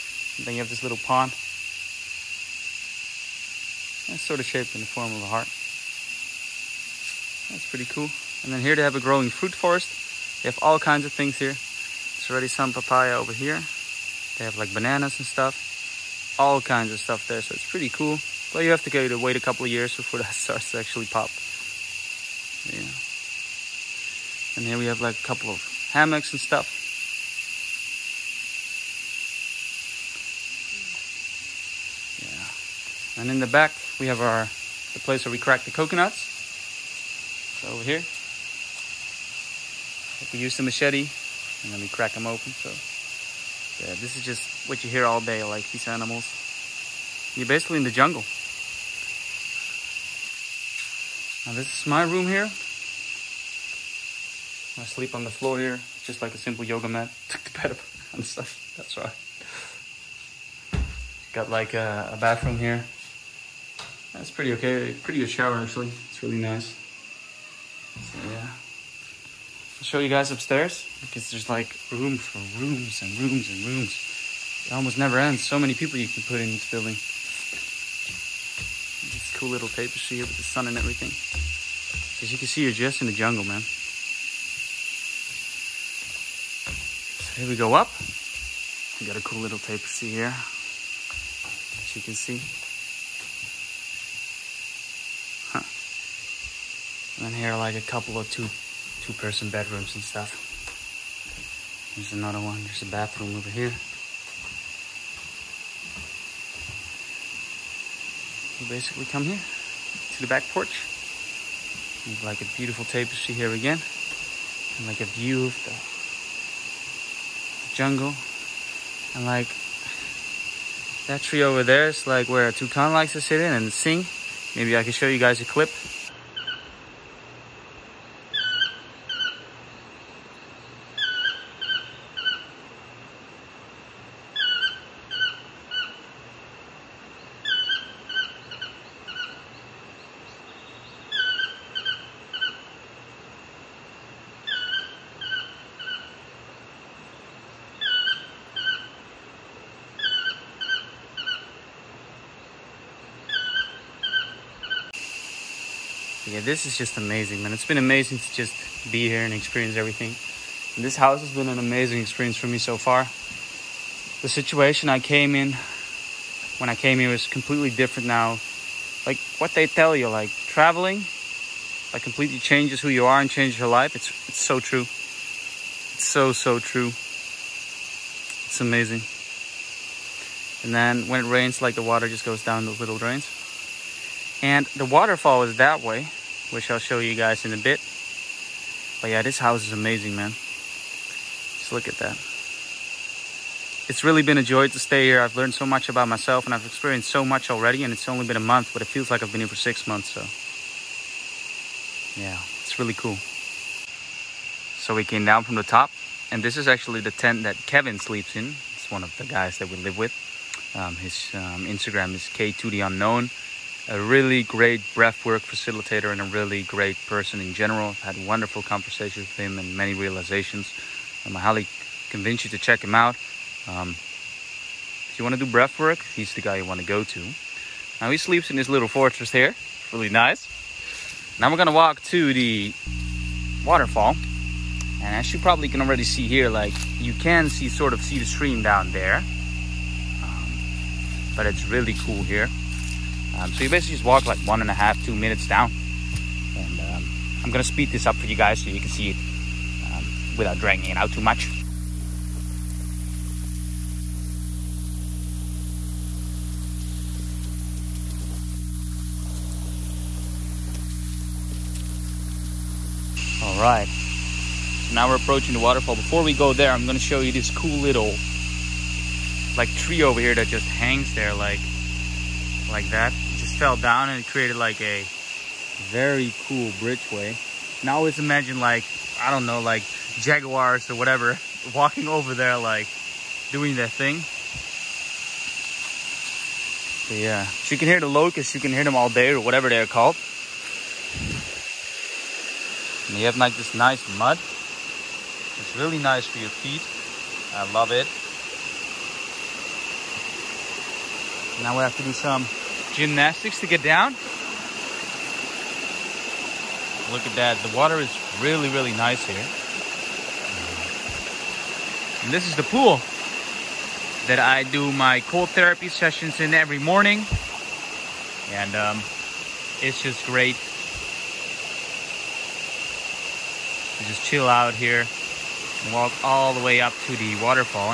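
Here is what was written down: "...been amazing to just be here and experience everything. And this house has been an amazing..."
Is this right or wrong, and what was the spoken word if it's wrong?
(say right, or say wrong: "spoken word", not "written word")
right.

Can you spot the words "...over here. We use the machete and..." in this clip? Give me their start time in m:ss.
0:37.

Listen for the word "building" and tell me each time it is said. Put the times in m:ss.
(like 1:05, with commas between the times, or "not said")
1:16.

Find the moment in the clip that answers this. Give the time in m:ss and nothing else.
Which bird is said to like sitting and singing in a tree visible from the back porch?
2:02.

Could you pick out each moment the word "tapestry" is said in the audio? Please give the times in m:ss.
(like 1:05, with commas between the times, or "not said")
1:19, 1:29, 1:52.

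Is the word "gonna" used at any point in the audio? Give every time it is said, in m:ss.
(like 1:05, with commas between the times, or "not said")
3:51, 4:07, 4:26.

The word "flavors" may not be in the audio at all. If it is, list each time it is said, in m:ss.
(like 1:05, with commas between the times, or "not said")
not said.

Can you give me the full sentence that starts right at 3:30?
Um, his um, Instagram is K2 theunknown Unknown a really great breathwork facilitator and a really great person in general.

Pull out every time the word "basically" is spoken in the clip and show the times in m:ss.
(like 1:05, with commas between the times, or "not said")
0:47, 1:48, 4:03.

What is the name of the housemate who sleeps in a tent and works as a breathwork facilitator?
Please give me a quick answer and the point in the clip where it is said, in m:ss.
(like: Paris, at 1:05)
Kevin, at 3:27.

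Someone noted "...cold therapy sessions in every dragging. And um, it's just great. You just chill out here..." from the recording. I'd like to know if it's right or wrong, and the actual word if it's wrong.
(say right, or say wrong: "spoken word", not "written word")
wrong: "morning", not "dragging".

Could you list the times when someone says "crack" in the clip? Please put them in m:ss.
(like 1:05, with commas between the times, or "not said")
0:35, 0:41.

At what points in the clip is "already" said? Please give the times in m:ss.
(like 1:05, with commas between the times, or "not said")
0:12, 3:17, 3:55.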